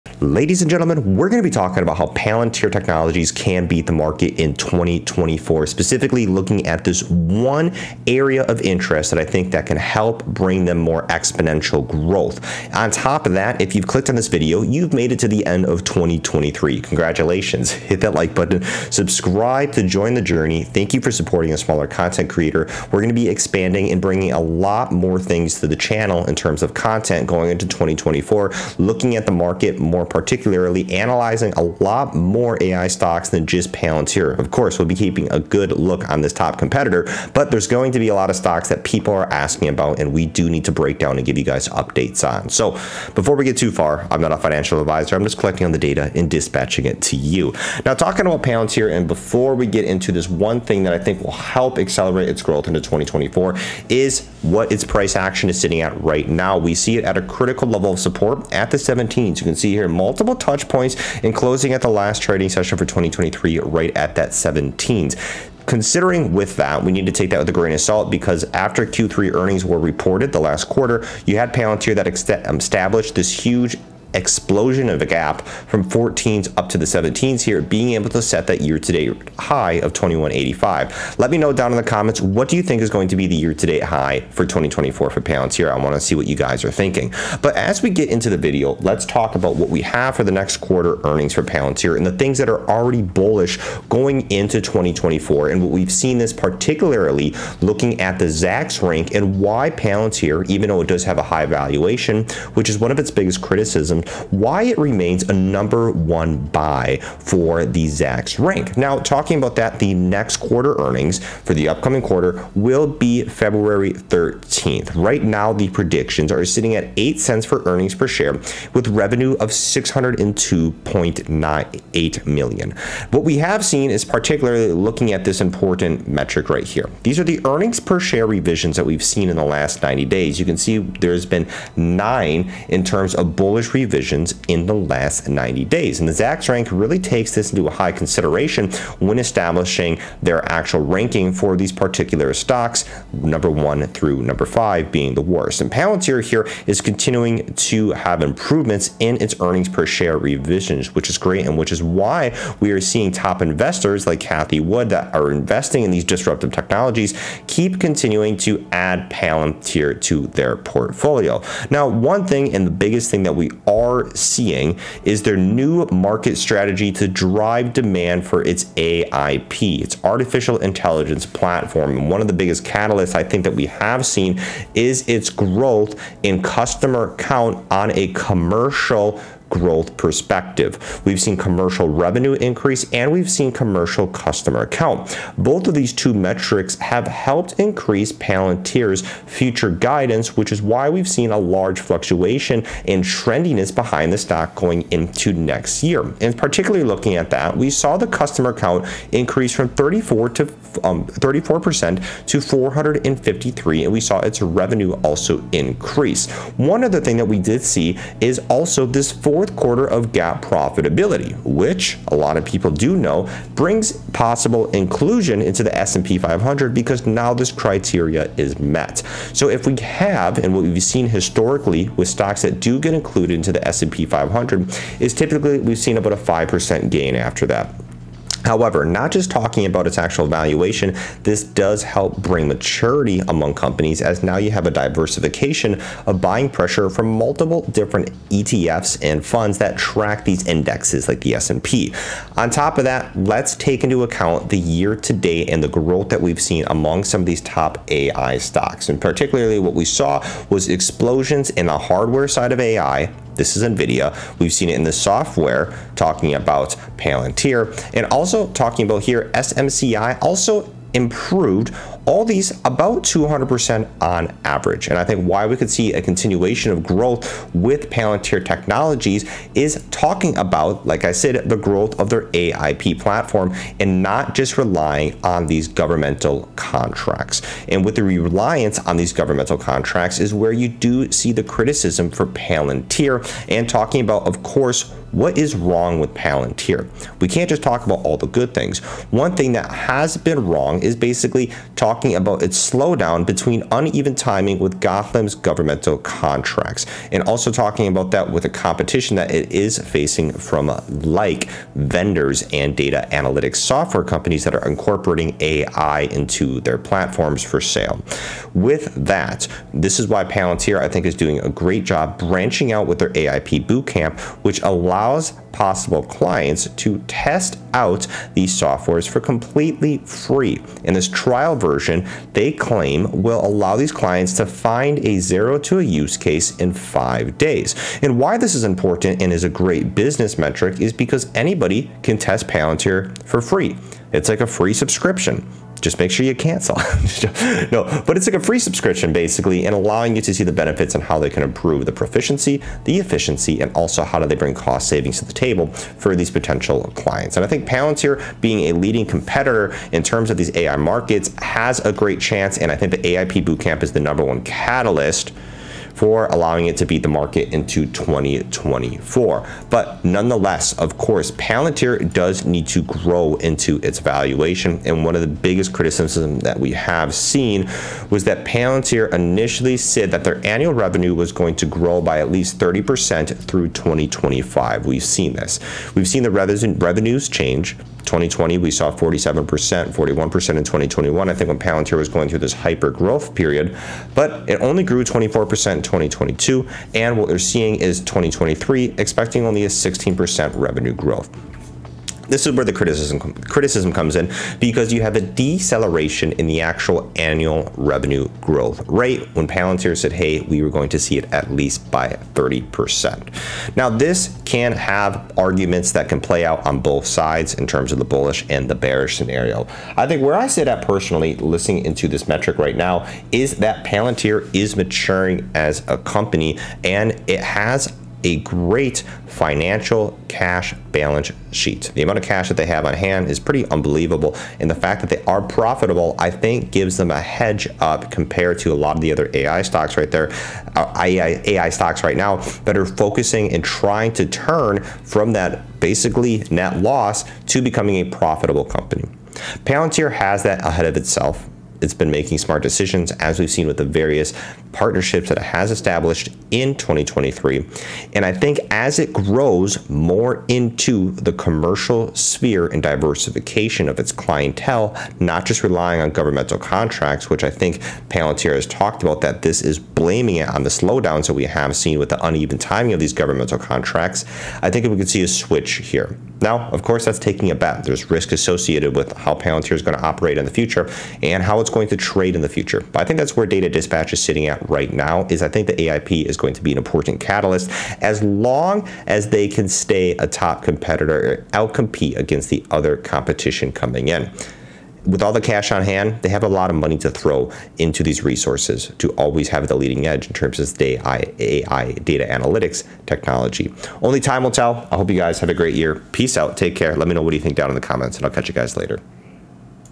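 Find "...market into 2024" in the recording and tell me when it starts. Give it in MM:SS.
05:57.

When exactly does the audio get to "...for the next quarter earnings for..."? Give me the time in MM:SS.
01:30.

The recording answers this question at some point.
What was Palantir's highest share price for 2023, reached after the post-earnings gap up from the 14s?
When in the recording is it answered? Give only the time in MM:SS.
01:19.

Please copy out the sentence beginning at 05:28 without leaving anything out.
And why this is important and is a great business metric is because anybody can test Palantir for free.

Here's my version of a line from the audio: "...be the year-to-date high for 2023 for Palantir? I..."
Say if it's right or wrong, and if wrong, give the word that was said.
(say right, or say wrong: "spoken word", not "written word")
wrong: "2024", not "2023".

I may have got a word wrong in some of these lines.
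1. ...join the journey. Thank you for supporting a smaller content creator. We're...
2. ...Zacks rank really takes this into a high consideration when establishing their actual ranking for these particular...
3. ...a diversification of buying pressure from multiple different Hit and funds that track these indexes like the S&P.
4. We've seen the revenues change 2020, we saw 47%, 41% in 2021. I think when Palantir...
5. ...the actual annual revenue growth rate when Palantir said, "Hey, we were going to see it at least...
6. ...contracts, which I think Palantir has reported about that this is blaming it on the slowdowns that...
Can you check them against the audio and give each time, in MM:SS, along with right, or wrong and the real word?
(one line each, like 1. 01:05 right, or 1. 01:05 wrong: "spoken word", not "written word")
1. 00:19 right
2. 02:16 right
3. 03:54 wrong: "ETFs", not "Hit"
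4. 06:15 right
5. 06:36 right
6. 07:36 wrong: "talked", not "reported".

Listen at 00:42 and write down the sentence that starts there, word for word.
So before we get too far, I'm not a financial advisor.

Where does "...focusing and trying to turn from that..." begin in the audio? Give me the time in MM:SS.
07:12.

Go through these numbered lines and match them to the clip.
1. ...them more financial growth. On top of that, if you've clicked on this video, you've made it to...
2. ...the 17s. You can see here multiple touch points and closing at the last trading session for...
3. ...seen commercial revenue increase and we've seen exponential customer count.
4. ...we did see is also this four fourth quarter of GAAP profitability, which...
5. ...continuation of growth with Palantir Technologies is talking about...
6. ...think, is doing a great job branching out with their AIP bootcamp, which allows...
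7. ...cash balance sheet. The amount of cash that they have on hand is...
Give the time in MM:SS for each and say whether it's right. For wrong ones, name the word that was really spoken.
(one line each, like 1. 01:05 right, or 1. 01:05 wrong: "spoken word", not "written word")
1. 00:10 wrong: "exponential", not "financial"
2. 00:58 right
3. 03:01 wrong: "commercial", not "exponential"
4. 03:27 right
5. 04:26 right
6. 05:10 right
7. 07:00 right.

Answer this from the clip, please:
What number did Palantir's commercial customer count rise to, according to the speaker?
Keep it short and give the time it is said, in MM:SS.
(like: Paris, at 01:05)
453, at 03:22.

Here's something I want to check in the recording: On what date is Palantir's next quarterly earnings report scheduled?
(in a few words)
February 13th.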